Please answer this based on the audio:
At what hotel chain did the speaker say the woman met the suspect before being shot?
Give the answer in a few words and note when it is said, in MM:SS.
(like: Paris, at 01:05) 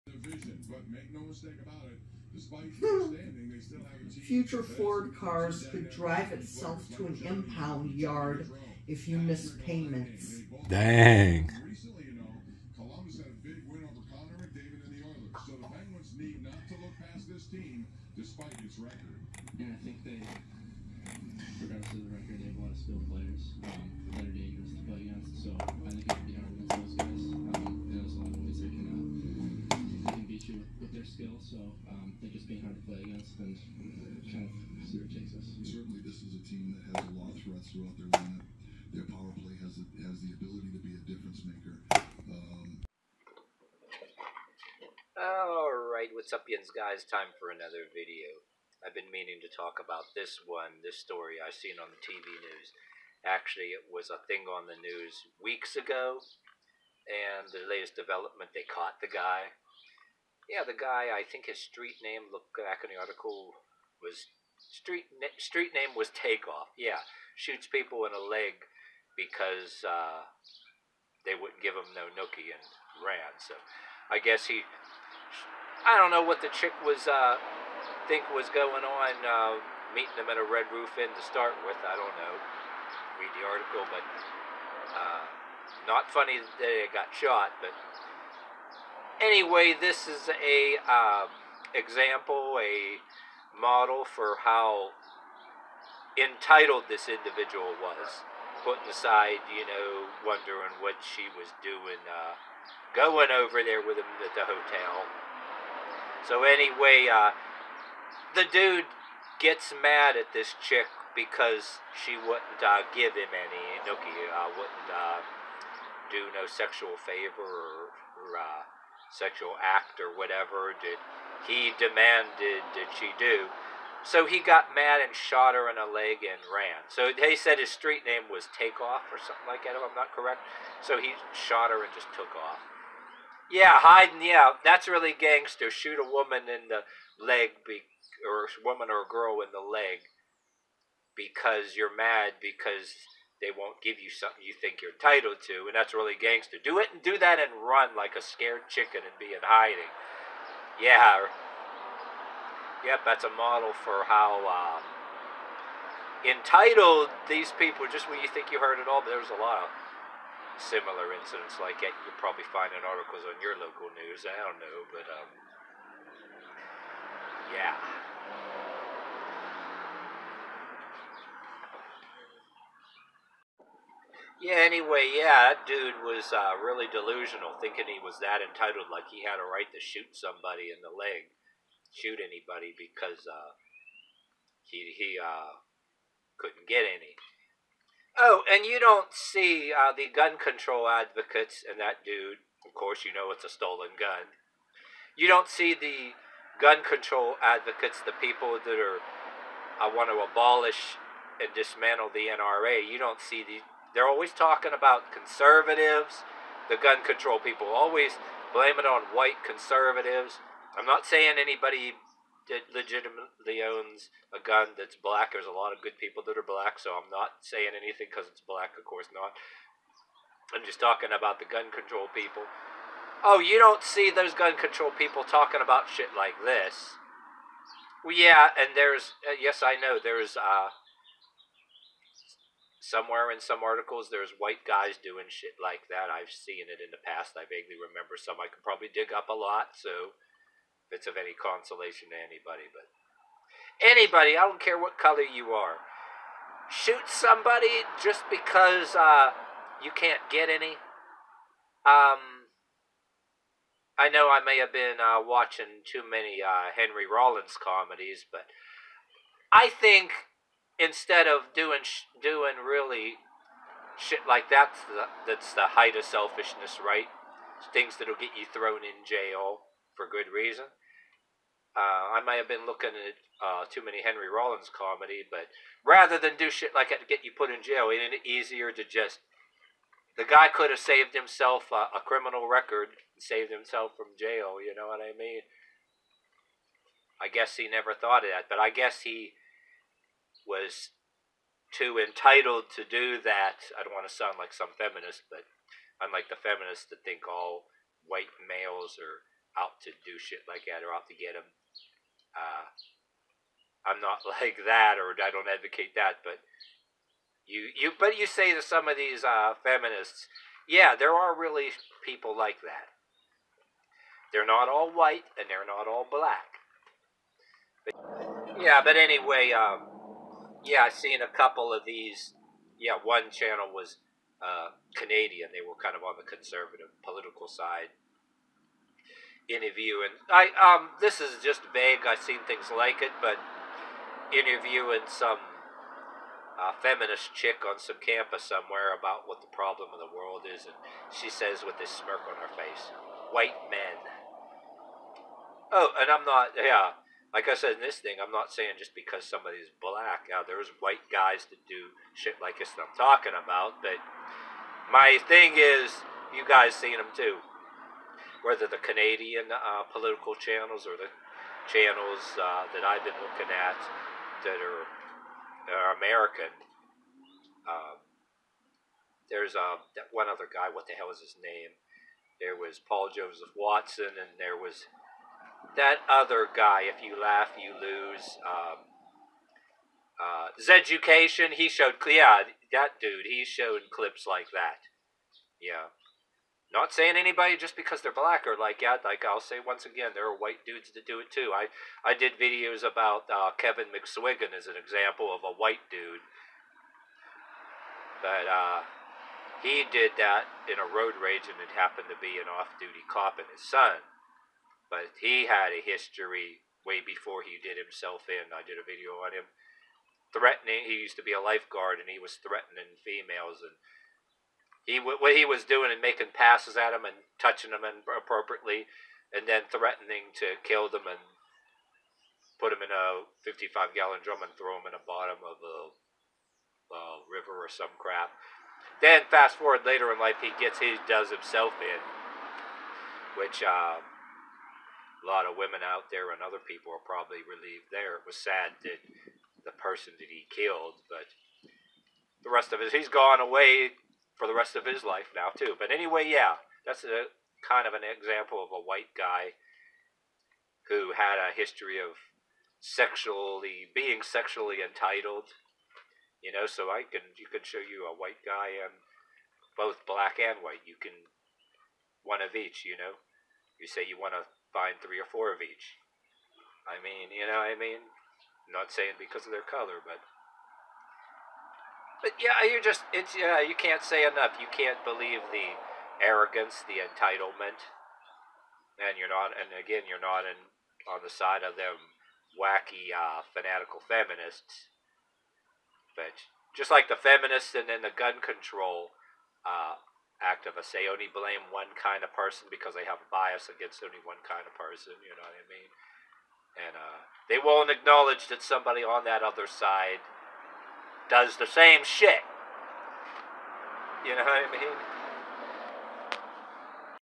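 Red Roof Inn, at 01:20.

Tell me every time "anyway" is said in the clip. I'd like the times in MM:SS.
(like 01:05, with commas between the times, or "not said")
01:29, 01:46, 02:54, 05:18, 07:25.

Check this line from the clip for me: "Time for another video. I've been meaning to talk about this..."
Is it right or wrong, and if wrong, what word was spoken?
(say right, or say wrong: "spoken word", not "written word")
right.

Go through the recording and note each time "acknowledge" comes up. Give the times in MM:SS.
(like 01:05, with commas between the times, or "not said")
08:17.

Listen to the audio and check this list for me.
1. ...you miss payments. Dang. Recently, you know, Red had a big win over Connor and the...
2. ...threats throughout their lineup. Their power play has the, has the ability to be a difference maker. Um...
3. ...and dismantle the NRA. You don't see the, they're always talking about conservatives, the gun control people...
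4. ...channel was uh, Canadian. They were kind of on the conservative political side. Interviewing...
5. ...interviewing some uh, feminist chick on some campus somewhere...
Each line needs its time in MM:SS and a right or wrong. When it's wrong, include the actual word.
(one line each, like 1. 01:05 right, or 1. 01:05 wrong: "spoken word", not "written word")
1. 00:09 wrong: "Columbus", not "Red"
2. 00:37 right
3. 03:21 right
4. 05:23 right
5. 05:34 right.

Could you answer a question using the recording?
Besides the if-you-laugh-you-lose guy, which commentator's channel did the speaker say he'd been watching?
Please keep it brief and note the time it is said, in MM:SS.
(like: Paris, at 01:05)
Paul Joseph Watson, at 06:12.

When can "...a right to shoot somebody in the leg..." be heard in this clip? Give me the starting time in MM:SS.
02:59.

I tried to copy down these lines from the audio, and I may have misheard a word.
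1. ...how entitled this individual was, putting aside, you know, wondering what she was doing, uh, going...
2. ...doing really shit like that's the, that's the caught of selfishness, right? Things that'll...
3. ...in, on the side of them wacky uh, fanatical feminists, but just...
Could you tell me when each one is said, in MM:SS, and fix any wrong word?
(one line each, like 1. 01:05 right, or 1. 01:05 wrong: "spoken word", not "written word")
1. 01:34 right
2. 04:22 wrong: "height", not "caught"
3. 08:00 right.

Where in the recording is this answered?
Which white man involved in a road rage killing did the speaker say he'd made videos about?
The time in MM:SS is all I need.
06:33.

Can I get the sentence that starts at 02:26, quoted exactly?
Do it and do that and run like a scared chicken and be in hiding.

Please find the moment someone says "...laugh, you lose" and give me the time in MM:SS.
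06:17.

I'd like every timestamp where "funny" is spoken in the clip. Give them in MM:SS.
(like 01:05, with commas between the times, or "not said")
01:26.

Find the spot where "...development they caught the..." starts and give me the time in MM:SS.
00:57.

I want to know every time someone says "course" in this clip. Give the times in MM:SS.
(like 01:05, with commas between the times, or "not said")
03:12, 03:38.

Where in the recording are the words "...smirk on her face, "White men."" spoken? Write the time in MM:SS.
05:41.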